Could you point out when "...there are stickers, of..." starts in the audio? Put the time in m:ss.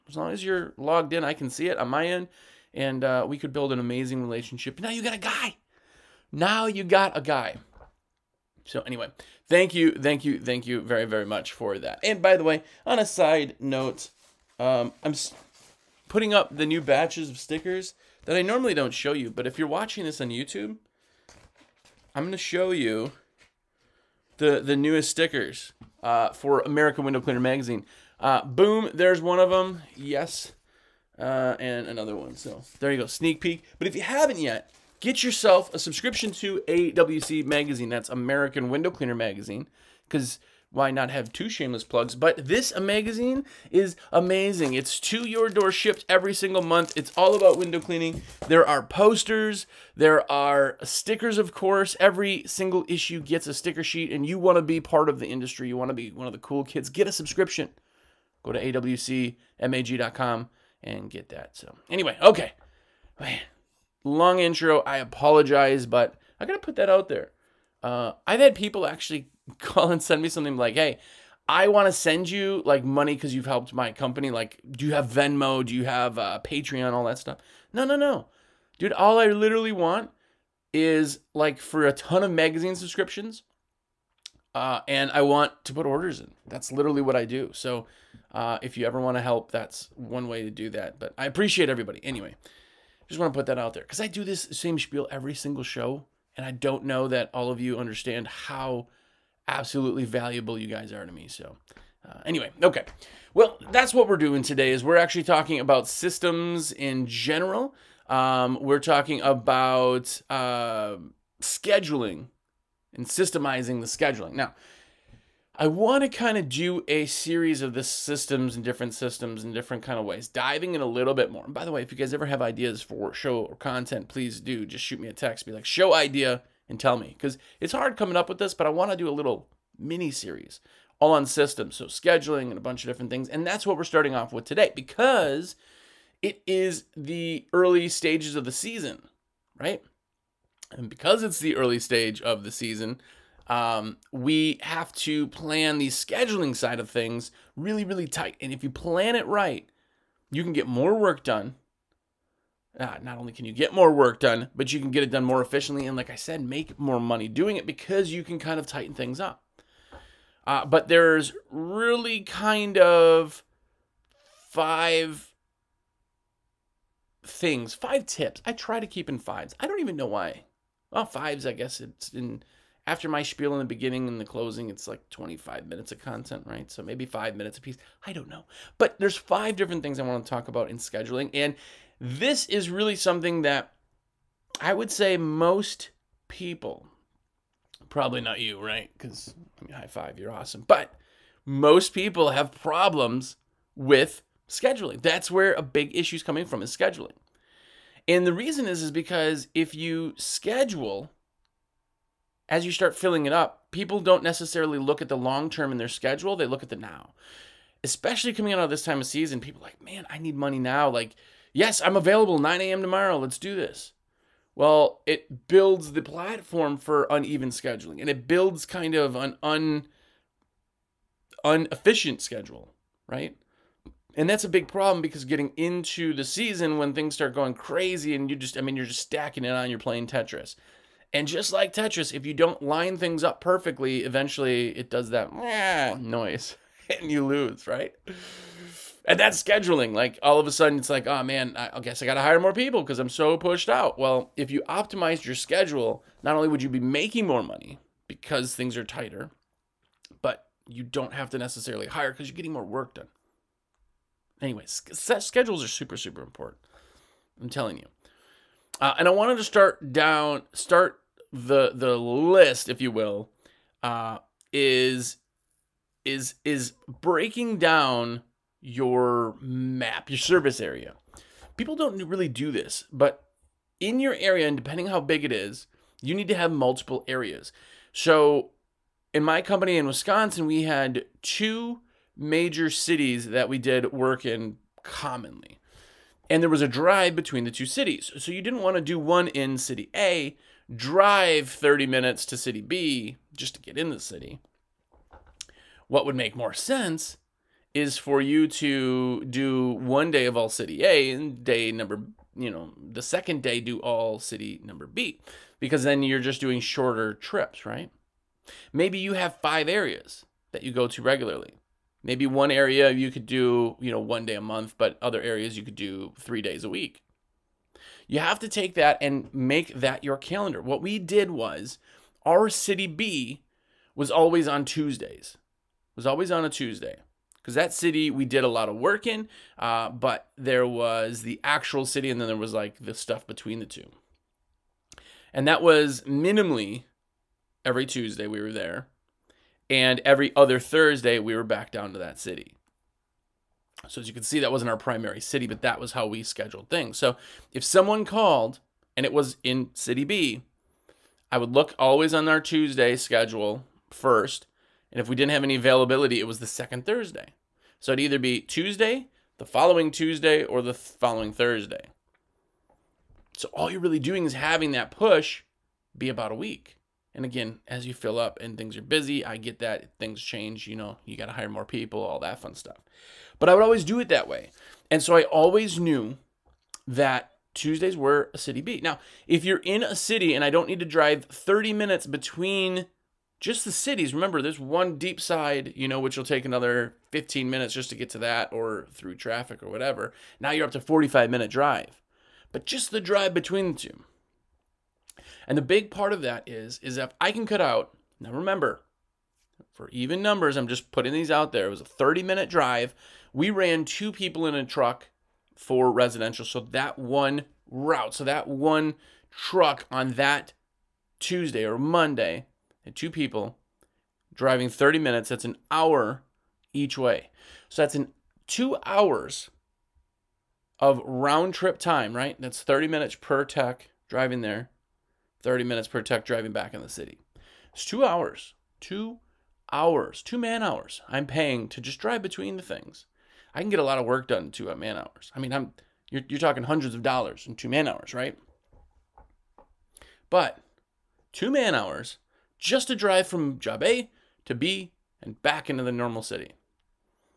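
0:49.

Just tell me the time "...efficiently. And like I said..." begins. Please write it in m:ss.
2:35.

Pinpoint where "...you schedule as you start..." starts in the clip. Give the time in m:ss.
3:19.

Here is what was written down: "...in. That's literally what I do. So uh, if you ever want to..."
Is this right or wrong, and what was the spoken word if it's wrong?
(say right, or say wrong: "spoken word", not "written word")
right.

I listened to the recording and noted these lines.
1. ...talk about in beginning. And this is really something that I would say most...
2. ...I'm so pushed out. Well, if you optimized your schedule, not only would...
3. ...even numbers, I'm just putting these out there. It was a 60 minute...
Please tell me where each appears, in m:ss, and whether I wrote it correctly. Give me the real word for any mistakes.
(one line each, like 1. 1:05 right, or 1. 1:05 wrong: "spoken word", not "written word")
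1. 3:00 wrong: "scheduling", not "beginning"
2. 4:02 right
3. 6:39 wrong: "30", not "60".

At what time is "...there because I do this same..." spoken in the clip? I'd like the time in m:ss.
1:33.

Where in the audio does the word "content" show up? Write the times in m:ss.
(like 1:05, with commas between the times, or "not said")
2:03, 2:55.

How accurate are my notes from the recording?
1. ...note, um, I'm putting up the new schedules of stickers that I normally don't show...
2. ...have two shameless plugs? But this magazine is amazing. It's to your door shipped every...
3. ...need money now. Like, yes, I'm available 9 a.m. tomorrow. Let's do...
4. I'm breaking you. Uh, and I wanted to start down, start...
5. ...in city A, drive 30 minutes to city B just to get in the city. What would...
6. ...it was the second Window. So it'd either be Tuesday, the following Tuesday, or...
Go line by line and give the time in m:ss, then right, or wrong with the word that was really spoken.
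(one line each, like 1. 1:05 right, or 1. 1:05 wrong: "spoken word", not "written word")
1. 0:13 wrong: "batches", not "schedules"
2. 0:41 right
3. 3:30 right
4. 4:17 wrong: "telling", not "breaking"
5. 4:49 right
6. 5:56 wrong: "Thursday", not "Window".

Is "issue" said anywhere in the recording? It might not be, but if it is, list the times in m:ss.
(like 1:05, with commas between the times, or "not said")
0:52, 3:15.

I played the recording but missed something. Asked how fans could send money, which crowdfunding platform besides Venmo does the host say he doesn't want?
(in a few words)
Patreon.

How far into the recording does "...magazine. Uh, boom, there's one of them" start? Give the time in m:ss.
0:27.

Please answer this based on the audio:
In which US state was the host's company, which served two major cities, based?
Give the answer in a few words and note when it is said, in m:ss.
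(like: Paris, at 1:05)
Wisconsin, at 4:39.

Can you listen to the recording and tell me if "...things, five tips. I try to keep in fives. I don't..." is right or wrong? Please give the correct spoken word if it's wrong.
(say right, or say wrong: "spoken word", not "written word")
right.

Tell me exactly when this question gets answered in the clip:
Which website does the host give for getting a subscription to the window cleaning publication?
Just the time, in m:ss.
0:58.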